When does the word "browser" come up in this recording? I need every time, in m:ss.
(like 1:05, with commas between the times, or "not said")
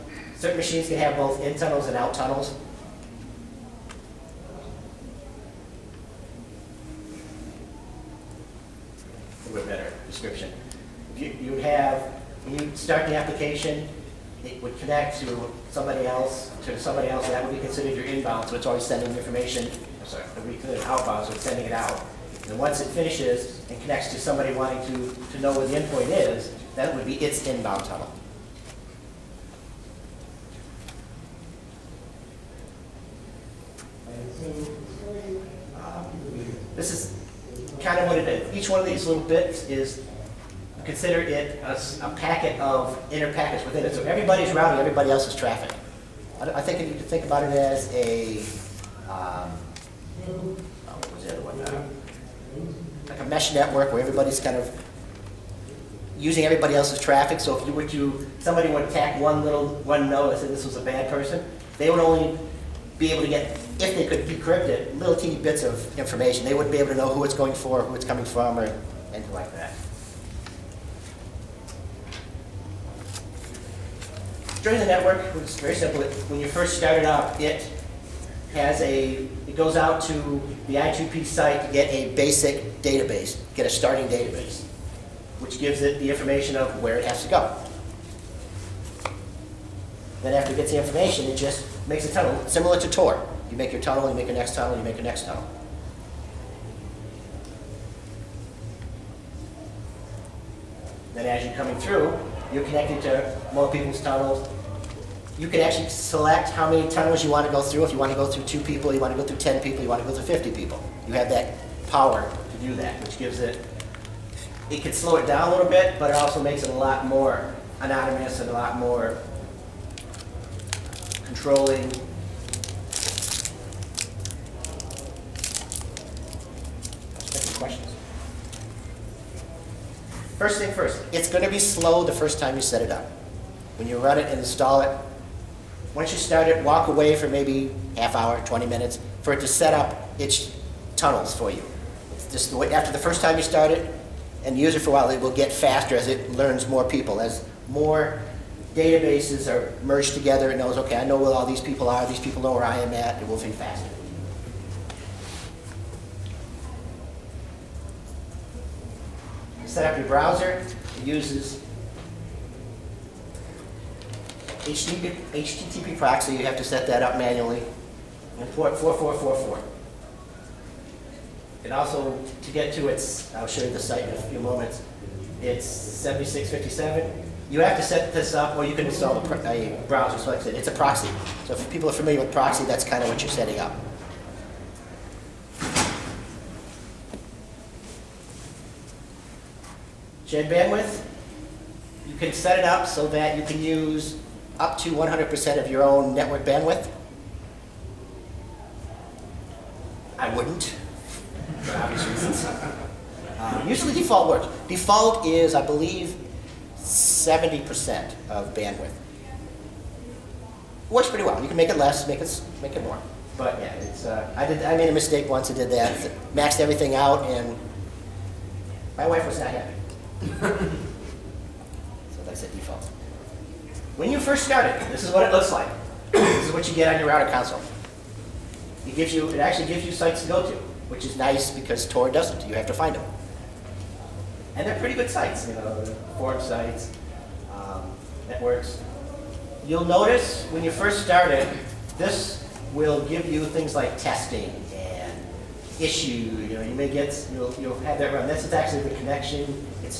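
2:40, 2:59.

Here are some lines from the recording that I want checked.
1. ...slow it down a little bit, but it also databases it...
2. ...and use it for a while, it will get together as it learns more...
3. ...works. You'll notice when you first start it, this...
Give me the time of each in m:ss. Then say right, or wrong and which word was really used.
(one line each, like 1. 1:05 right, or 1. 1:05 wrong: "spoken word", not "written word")
1. 1:54 wrong: "makes", not "databases"
2. 2:24 wrong: "faster", not "together"
3. 3:58 wrong: "networks", not "works".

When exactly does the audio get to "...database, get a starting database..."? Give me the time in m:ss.
1:22.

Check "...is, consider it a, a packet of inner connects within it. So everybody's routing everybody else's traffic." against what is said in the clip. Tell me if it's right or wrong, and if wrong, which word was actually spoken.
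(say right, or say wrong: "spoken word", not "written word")
wrong: "packets", not "connects".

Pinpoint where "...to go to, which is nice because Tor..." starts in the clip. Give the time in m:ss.
3:50.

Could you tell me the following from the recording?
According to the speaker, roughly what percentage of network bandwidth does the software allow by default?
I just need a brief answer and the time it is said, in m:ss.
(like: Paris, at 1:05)
70%, at 3:26.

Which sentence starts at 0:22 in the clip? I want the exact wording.
And once it finishes and connects to somebody wanting to, to know where the endpoint is, that would be its inbound tunnel.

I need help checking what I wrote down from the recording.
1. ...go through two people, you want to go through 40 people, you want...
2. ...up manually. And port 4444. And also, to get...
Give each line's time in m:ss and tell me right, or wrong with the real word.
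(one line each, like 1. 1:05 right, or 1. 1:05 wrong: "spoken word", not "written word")
1. 1:48 wrong: "10", not "40"
2. 2:47 right.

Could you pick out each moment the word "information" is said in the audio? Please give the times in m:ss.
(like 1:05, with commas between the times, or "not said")
0:19, 1:05, 1:26, 1:30.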